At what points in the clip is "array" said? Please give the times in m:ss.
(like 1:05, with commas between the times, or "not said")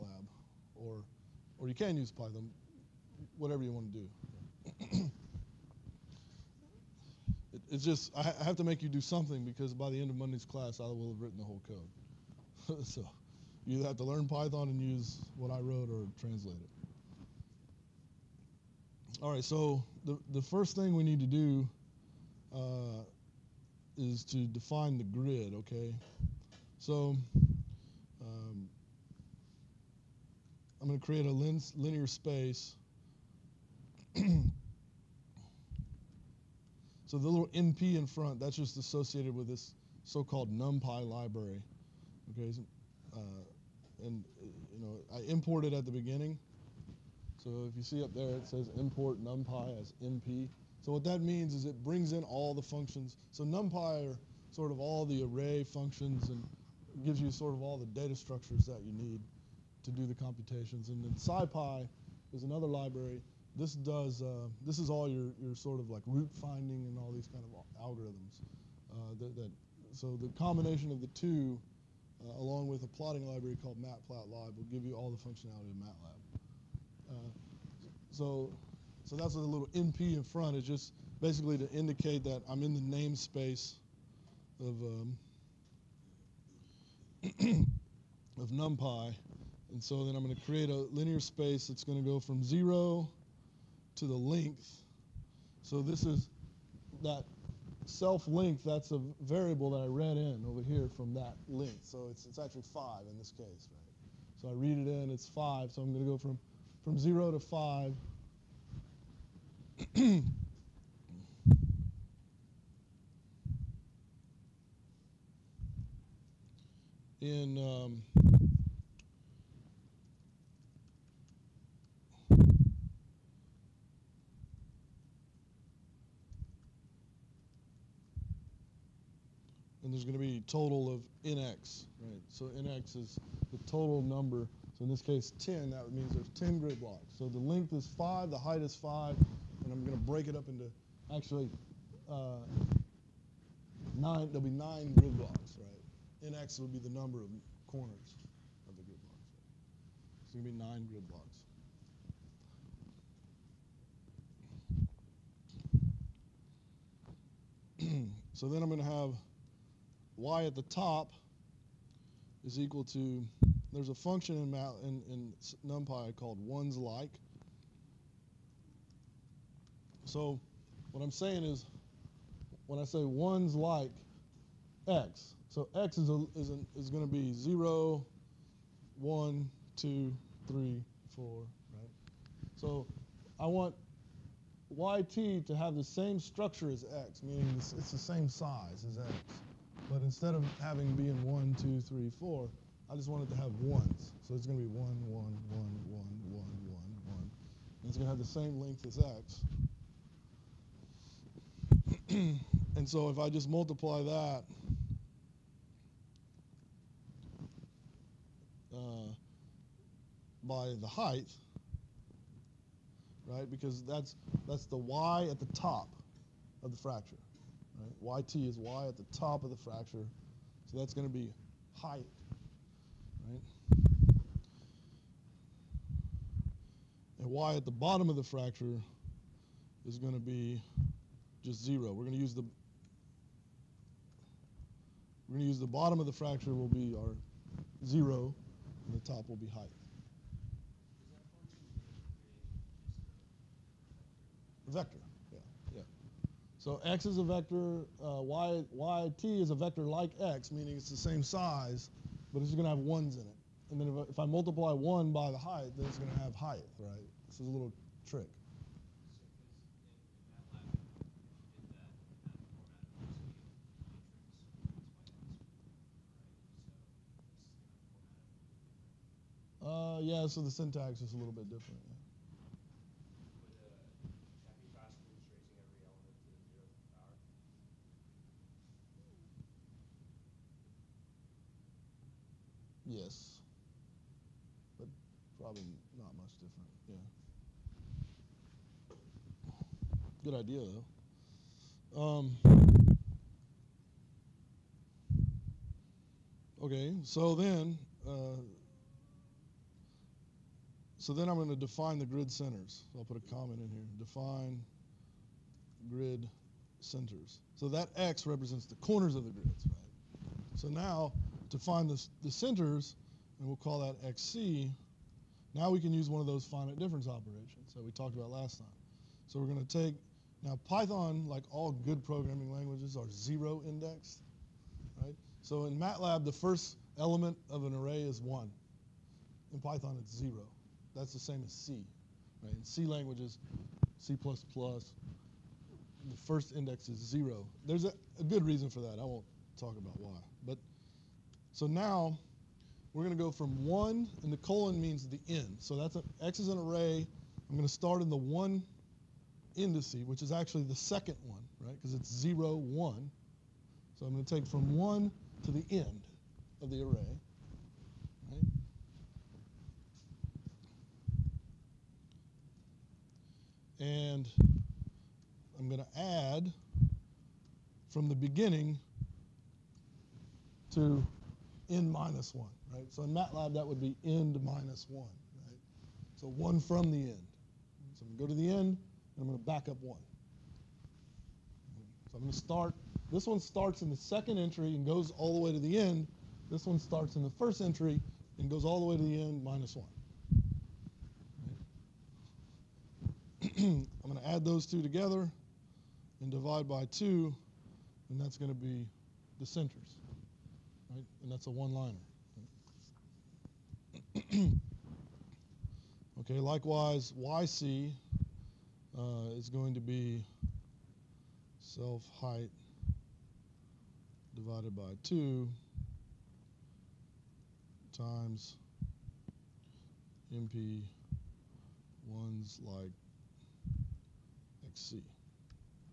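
0:55, 5:27, 5:46, 5:56.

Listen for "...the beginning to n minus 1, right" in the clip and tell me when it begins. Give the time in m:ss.
6:08.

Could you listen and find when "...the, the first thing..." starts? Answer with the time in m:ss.
0:20.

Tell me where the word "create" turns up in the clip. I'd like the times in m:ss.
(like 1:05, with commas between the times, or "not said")
0:31, 1:30.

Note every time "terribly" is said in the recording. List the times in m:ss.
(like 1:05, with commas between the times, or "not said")
not said.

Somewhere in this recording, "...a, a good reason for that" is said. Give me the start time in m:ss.
5:37.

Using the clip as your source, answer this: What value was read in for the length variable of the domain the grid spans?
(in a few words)
5.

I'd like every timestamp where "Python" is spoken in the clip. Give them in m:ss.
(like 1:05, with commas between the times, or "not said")
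0:02, 0:14, 5:20, 5:29.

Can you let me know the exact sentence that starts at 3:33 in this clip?
Because that's, that's the y at the top of the fracture.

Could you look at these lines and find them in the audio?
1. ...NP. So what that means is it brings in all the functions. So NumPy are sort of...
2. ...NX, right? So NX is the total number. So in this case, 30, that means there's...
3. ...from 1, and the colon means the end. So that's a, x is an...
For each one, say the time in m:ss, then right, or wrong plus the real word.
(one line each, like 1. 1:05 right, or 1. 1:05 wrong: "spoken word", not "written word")
1. 0:50 right
2. 2:11 wrong: "10", not "30"
3. 5:43 right.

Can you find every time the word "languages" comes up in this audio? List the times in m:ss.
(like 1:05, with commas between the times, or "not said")
5:22, 5:32.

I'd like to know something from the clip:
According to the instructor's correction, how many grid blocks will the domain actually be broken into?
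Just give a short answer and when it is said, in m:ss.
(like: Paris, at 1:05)
9, at 2:24.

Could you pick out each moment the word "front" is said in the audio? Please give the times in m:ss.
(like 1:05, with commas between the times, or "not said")
0:38, 1:20.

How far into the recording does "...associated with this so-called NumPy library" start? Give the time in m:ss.
0:38.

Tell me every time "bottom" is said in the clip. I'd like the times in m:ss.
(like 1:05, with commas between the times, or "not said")
3:47, 3:55.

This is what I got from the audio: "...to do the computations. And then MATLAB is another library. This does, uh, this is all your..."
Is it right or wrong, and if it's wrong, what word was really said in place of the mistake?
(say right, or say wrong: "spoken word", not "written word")
wrong: "SciPy", not "MATLAB".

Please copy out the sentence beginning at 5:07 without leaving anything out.
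So that X represents the corners of the grids, right?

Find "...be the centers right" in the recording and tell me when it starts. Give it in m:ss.
6:38.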